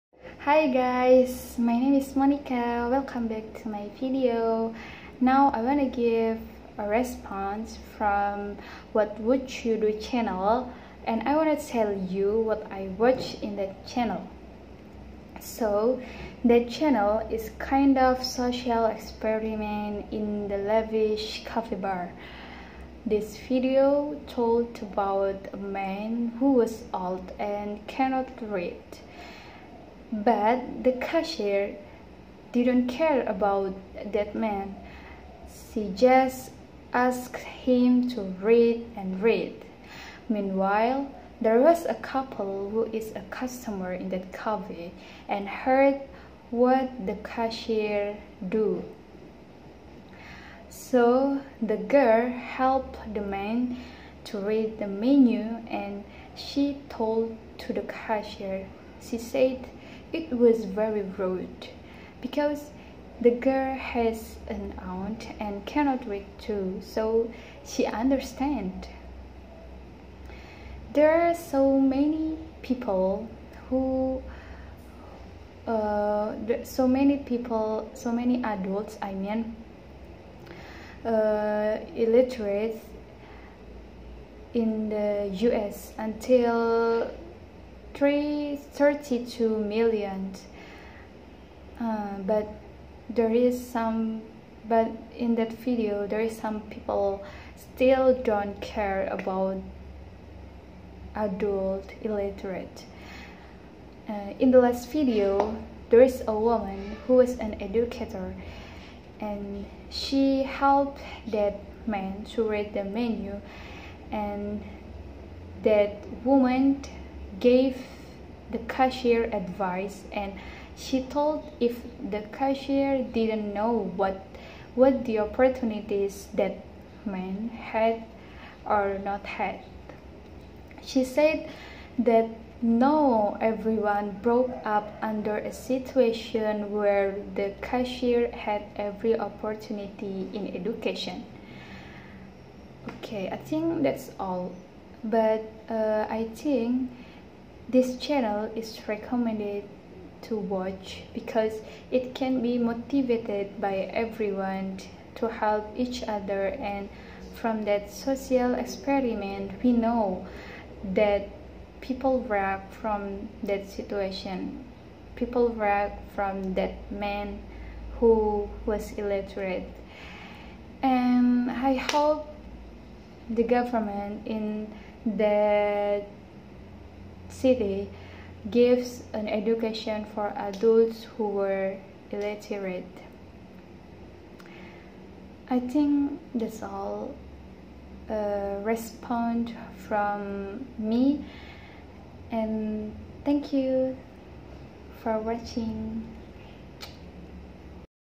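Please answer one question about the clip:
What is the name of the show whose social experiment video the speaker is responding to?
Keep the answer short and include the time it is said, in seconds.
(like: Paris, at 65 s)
What Would You Do, at 8 s.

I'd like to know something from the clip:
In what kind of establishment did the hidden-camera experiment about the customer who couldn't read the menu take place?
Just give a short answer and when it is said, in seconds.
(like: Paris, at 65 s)
Lavish coffee bar, at 20 s.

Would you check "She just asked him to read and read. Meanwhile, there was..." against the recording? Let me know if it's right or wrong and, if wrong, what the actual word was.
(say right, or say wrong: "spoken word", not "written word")
right.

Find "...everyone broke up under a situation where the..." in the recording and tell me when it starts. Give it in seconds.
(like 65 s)
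133 s.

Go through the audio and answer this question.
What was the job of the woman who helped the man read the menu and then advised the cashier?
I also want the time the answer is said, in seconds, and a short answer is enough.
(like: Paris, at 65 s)
Educator, at 107 s.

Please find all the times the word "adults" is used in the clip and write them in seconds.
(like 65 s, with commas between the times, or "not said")
78 s, 101 s, 180 s.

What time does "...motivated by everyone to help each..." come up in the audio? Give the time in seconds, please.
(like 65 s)
152 s.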